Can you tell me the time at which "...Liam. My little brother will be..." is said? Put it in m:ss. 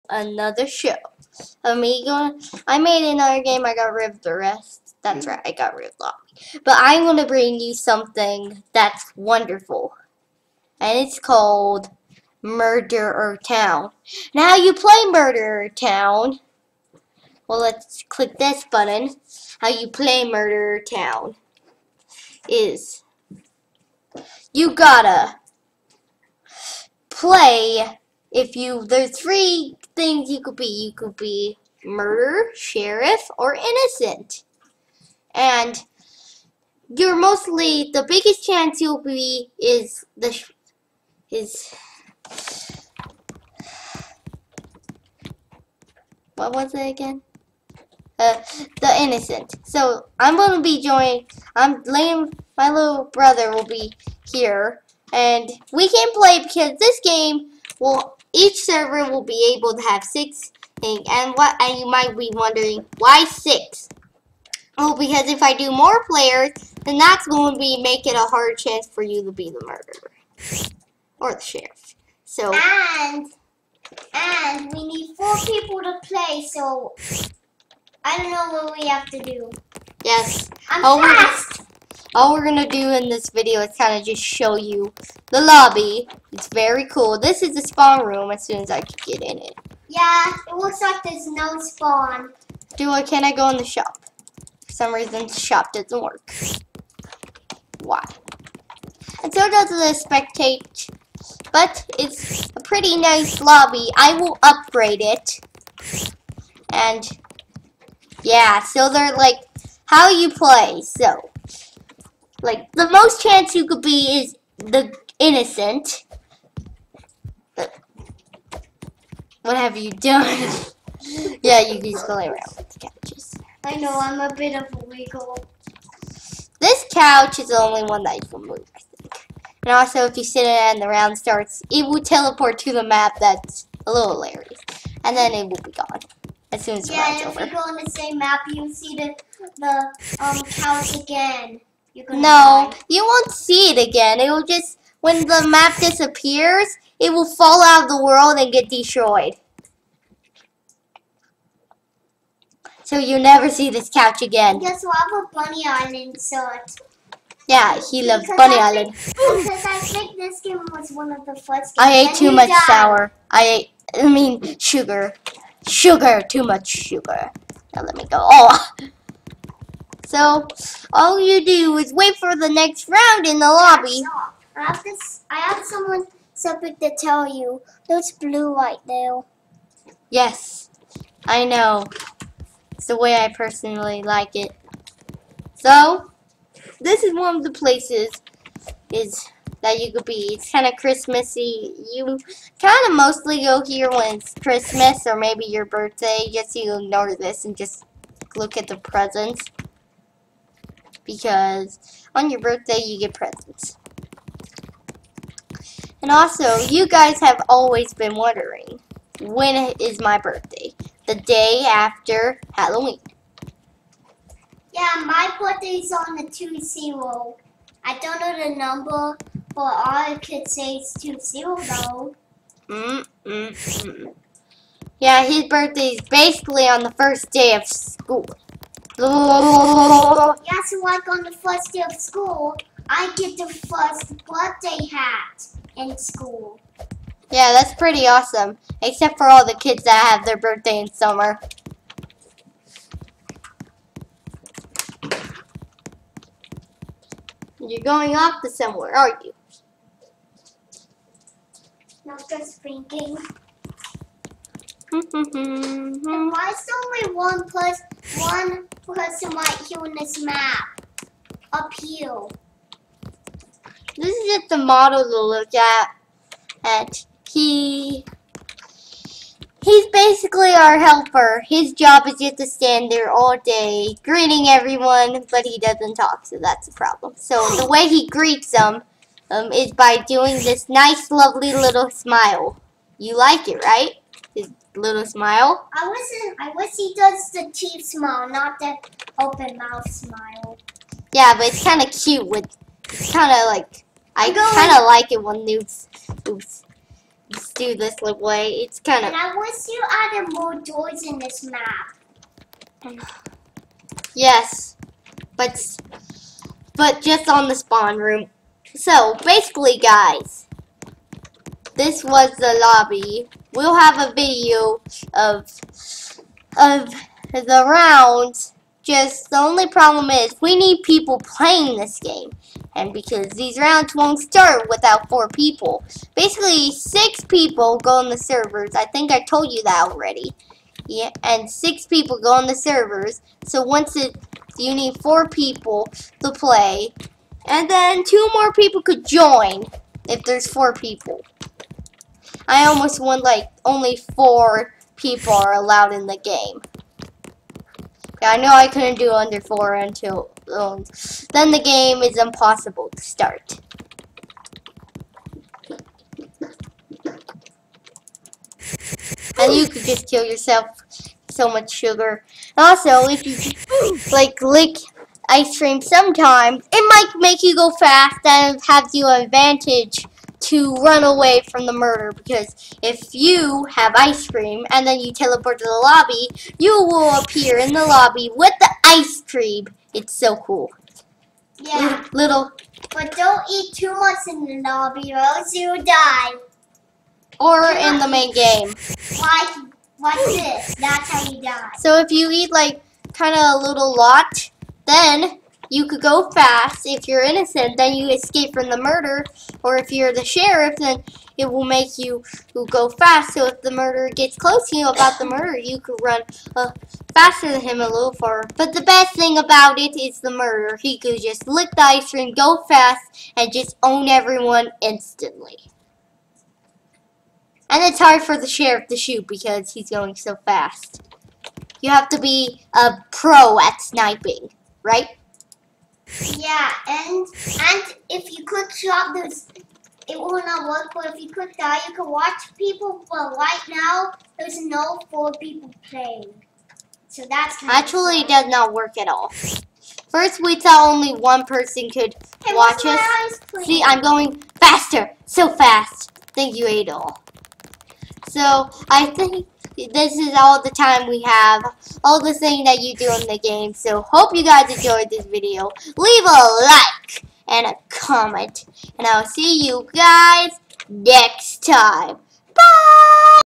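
0:51.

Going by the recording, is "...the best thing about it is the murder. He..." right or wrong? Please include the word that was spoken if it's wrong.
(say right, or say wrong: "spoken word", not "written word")
right.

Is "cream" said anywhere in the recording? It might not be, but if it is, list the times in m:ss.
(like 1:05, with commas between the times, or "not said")
6:05, 6:14, 6:19, 6:52.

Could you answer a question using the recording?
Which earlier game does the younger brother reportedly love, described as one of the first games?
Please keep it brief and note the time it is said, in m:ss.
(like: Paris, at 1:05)
Bunny Island, at 2:35.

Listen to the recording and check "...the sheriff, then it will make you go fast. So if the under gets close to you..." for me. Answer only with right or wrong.
wrong.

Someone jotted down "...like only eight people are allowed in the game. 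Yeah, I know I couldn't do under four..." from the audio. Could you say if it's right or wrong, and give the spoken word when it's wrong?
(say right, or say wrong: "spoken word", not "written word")
wrong: "four", not "eight".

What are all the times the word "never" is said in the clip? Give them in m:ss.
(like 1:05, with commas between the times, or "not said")
2:33.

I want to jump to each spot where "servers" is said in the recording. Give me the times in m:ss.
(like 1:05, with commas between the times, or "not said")
0:58, 5:28, 5:32.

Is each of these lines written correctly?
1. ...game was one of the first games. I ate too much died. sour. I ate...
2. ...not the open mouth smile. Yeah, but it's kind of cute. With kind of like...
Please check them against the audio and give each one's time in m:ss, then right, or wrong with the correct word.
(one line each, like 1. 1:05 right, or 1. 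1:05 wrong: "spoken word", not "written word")
1. 2:40 right
2. 4:48 right.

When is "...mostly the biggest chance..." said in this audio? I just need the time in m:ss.
0:37.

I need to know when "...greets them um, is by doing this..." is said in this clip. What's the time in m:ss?
4:38.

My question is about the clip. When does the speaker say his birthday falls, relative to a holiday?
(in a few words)
The day after Halloween.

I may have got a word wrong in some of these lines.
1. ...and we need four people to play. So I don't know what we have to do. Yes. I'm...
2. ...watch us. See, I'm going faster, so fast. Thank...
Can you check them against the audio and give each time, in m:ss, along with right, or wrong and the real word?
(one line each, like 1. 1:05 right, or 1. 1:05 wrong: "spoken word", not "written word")
1. 1:14 right
2. 7:22 right.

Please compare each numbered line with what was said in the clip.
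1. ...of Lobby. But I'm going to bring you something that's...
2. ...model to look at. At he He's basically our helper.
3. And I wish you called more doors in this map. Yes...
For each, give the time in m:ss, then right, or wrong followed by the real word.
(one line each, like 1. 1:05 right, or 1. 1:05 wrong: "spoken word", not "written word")
1. 0:05 right
2. 4:24 right
3. 4:59 wrong: "added", not "called".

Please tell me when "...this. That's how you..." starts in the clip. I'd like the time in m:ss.
6:30.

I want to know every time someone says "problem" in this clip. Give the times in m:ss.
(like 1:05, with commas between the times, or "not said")
4:36, 5:19.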